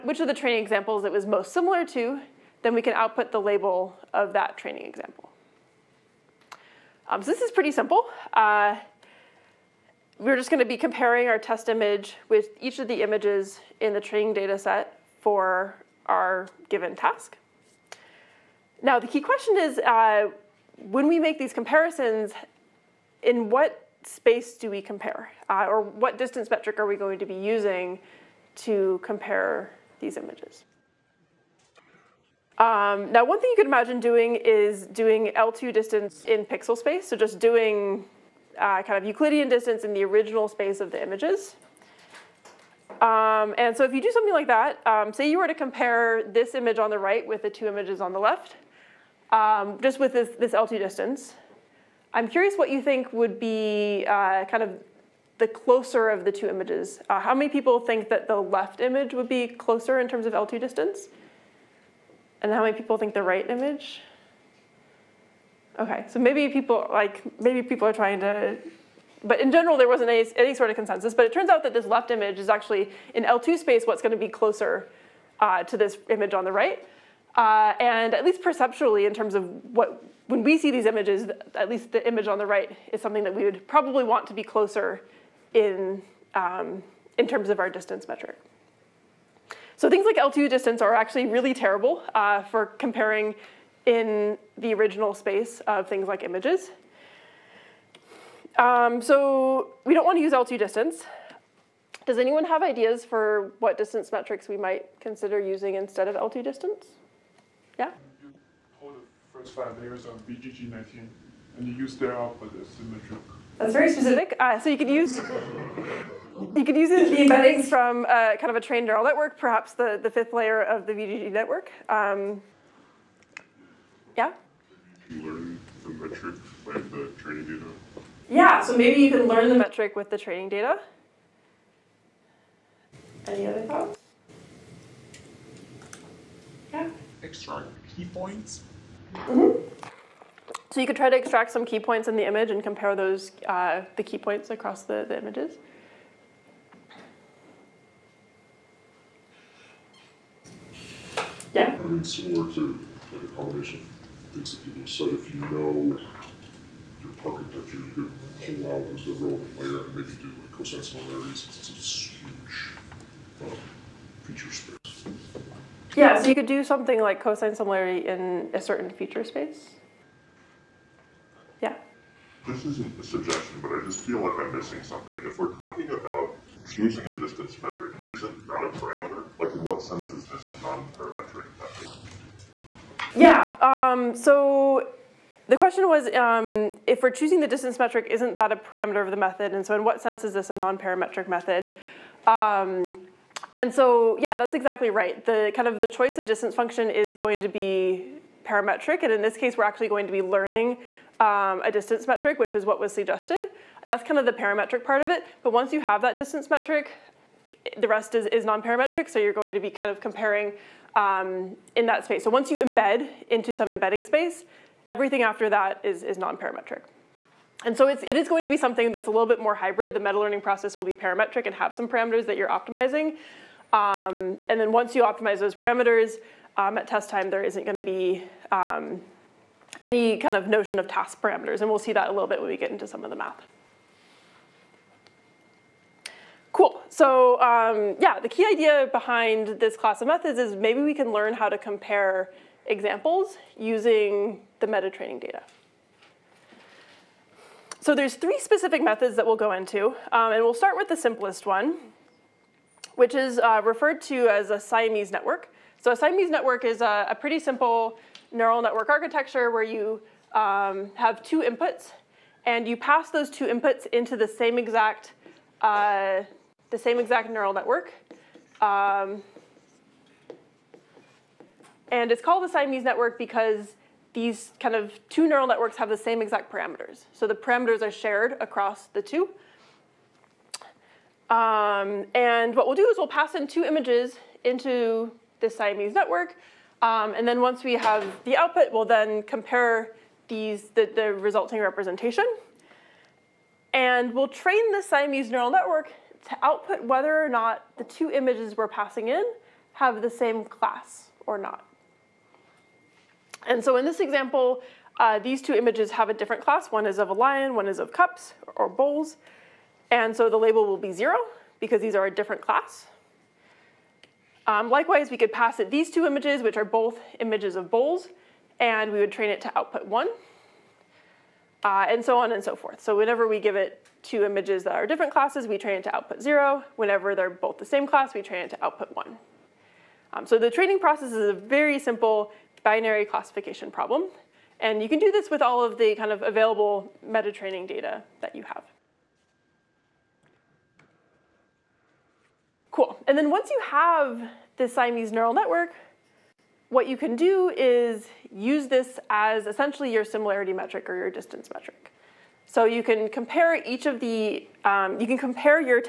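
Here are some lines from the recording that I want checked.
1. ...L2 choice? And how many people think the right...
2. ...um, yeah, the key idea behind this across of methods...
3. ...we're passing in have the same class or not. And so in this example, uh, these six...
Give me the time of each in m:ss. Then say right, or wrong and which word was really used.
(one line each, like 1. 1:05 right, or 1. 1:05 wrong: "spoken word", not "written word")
1. 1:00 wrong: "distance", not "choice"
2. 3:57 wrong: "class", not "across"
3. 4:58 wrong: "two", not "six".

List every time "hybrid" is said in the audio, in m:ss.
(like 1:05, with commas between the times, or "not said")
3:39.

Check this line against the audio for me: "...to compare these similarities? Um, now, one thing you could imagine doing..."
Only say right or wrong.
wrong.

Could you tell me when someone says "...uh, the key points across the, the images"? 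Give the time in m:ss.
2:23.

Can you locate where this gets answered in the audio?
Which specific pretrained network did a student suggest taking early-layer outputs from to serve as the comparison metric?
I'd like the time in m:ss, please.
1:50.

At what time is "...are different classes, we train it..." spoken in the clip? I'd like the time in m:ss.
5:24.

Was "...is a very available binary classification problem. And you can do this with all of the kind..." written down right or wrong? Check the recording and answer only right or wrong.
wrong.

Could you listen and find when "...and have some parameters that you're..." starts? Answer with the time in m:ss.
3:41.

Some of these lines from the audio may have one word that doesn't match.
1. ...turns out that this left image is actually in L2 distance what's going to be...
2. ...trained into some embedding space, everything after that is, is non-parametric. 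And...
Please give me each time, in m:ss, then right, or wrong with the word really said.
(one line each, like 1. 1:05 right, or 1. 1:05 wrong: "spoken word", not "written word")
1. 1:11 wrong: "space", not "distance"
2. 3:32 wrong: "embed", not "trained".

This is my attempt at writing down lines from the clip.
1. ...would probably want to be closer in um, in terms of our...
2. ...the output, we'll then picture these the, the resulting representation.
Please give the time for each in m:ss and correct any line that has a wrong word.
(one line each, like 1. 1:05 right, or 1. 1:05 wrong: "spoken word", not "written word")
1. 1:23 right
2. 4:48 wrong: "compare", not "picture".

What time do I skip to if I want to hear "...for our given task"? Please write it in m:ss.
0:15.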